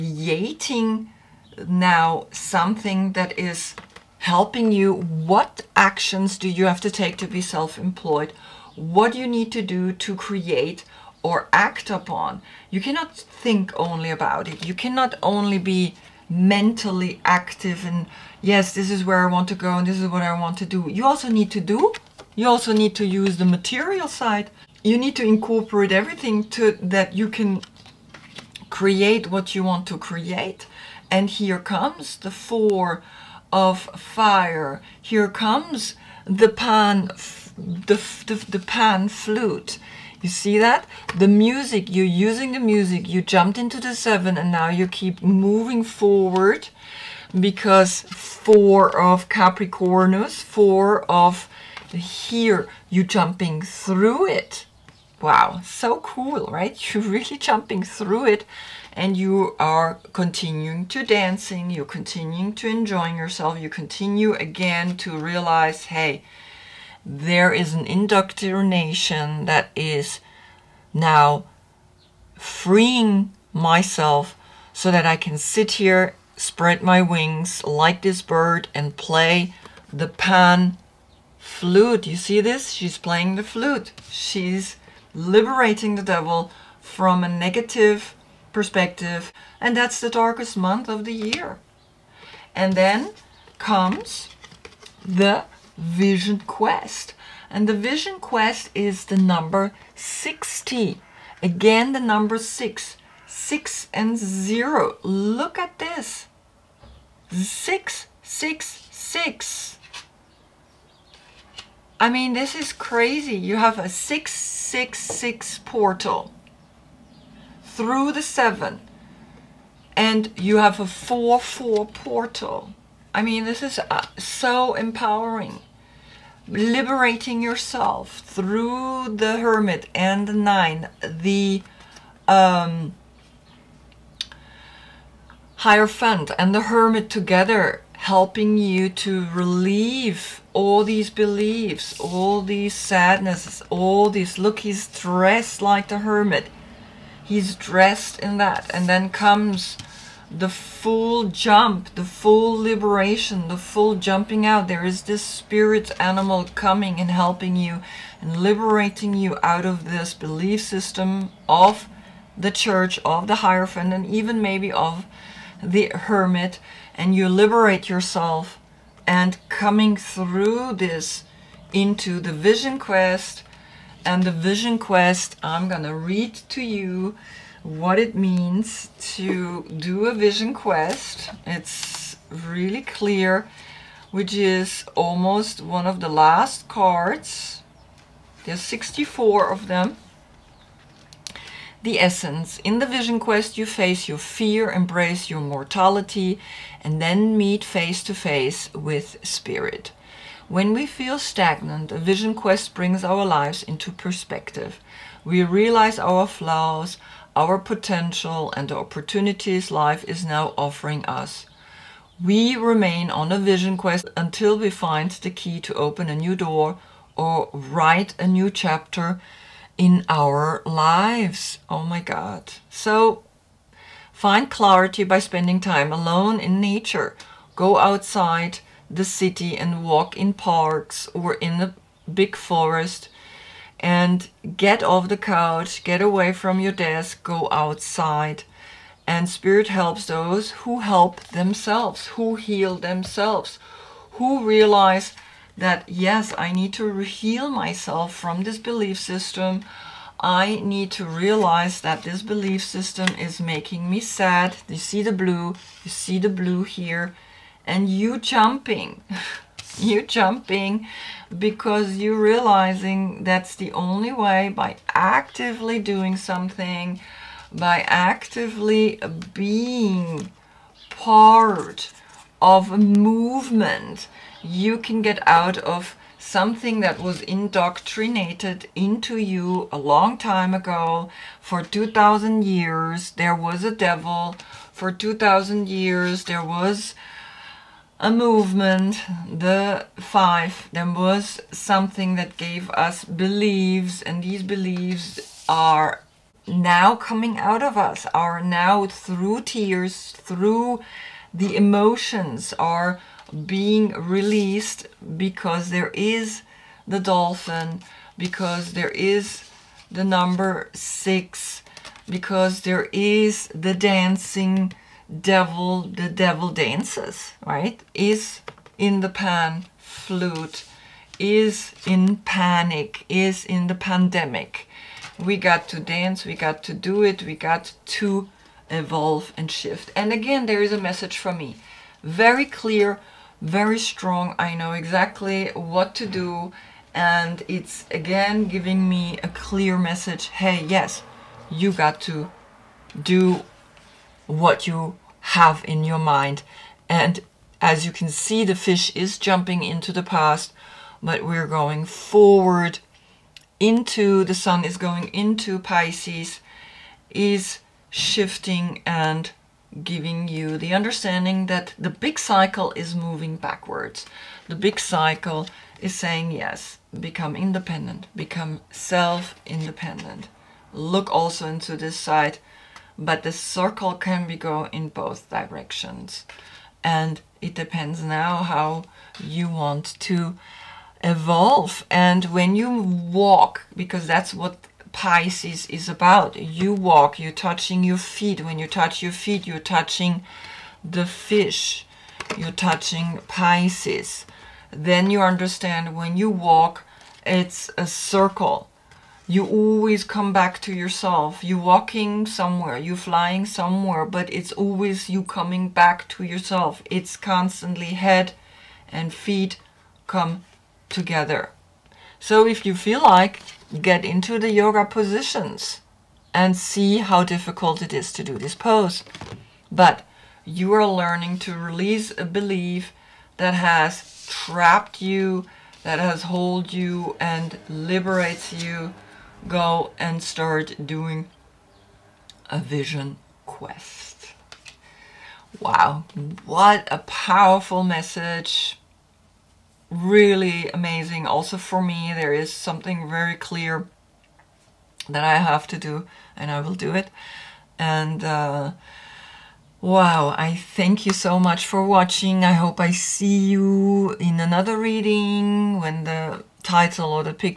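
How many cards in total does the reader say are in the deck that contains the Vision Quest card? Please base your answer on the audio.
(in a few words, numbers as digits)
64.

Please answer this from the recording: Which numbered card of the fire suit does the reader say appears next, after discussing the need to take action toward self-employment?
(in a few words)
4 of fire.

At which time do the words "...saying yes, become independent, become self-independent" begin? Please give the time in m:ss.
6:05.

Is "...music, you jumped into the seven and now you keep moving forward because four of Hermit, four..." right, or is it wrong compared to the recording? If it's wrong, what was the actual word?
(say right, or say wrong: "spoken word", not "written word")
wrong: "Capricornus", not "Hermit".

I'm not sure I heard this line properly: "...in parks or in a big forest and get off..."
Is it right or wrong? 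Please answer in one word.
right.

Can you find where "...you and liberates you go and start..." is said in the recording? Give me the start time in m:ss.
7:06.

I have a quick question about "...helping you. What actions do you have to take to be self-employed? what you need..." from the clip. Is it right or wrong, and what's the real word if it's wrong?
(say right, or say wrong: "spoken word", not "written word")
right.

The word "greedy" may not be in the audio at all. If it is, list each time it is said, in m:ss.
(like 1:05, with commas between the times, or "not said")
not said.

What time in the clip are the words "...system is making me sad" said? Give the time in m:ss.
4:12.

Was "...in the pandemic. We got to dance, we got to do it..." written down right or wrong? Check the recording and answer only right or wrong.
right.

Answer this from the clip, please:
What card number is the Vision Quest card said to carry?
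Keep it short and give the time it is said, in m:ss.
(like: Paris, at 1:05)
60, at 1:39.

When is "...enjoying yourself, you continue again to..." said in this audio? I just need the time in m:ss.
1:02.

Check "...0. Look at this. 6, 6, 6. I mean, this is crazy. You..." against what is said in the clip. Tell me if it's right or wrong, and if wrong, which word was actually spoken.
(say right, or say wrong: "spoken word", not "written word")
right.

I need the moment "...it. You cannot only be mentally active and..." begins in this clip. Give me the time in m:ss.
0:14.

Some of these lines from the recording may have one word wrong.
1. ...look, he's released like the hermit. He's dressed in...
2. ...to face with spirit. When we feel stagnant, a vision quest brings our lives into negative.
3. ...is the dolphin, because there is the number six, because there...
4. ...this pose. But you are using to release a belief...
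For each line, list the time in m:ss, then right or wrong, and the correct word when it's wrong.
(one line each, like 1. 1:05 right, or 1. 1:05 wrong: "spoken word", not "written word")
1. 2:24 wrong: "dressed", not "released"
2. 3:18 wrong: "perspective", not "negative"
3. 5:05 right
4. 6:58 wrong: "learning", not "using".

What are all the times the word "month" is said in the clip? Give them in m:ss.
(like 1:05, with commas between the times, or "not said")
1:30.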